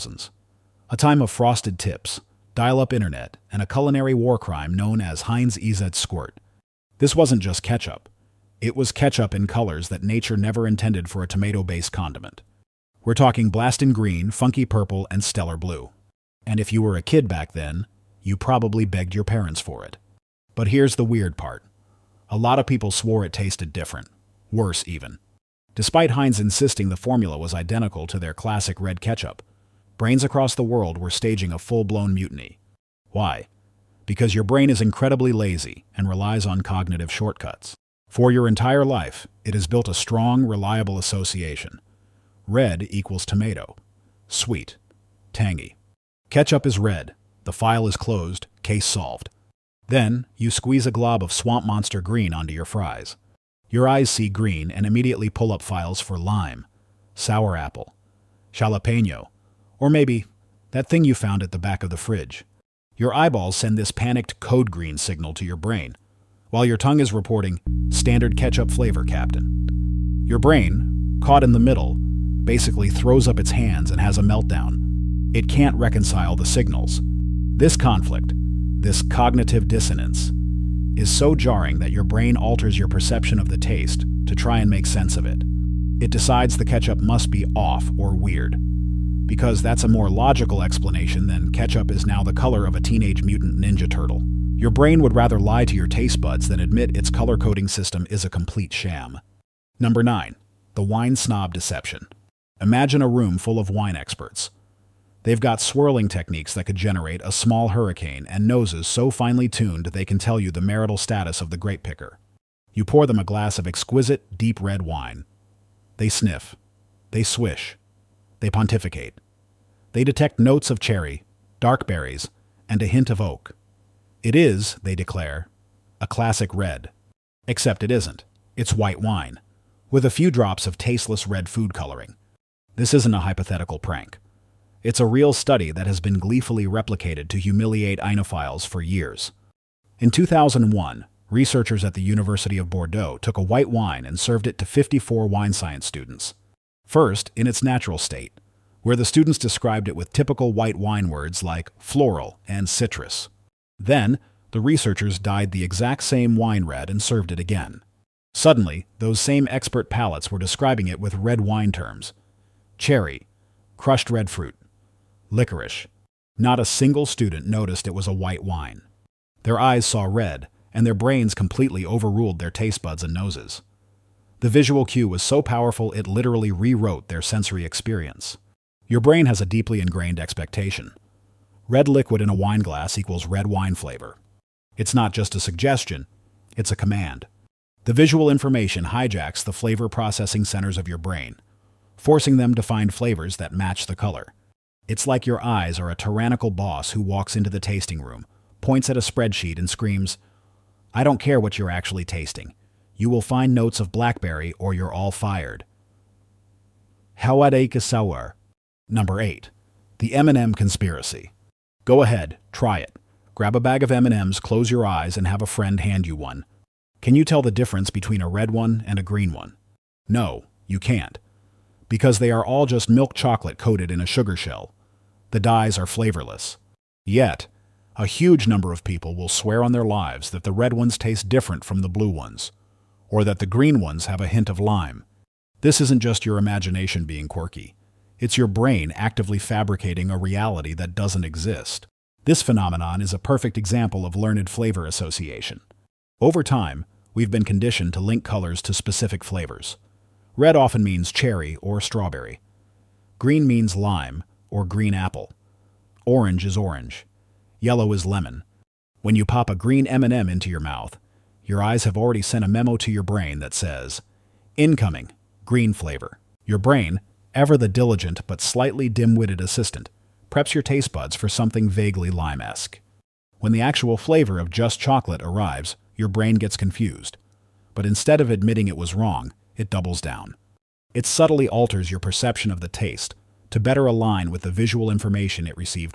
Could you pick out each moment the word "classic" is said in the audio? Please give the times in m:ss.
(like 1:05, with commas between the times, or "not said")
0:28, 2:06.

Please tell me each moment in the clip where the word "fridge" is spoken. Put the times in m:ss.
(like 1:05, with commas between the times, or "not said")
1:01.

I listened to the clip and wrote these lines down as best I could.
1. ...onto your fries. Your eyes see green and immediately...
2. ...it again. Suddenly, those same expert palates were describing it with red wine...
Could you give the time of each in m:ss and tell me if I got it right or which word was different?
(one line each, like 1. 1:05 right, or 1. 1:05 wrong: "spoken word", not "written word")
1. 0:52 right
2. 2:37 right.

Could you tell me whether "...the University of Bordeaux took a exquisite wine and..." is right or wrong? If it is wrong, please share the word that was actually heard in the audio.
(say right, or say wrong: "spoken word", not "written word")
wrong: "white", not "exquisite".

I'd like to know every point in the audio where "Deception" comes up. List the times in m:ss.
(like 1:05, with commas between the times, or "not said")
1:41.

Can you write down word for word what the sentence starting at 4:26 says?
Your brain, ever the diligent but slightly dim-witted assistant, preps your taste buds for something vaguely lime-esque.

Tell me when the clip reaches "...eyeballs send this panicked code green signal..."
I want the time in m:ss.
1:03.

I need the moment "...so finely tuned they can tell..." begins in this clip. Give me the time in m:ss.
1:48.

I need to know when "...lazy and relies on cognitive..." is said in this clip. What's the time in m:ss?
0:35.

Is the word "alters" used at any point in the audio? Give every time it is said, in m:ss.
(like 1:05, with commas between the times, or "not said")
1:22, 4:41.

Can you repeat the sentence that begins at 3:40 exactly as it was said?
No, you can't because they are all just milk chocolate coated in a sugar shell.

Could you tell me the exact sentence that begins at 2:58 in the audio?
Your brain has a deeply ingrained expectation.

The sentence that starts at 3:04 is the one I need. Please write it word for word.
It's not just a suggestion, it's a command.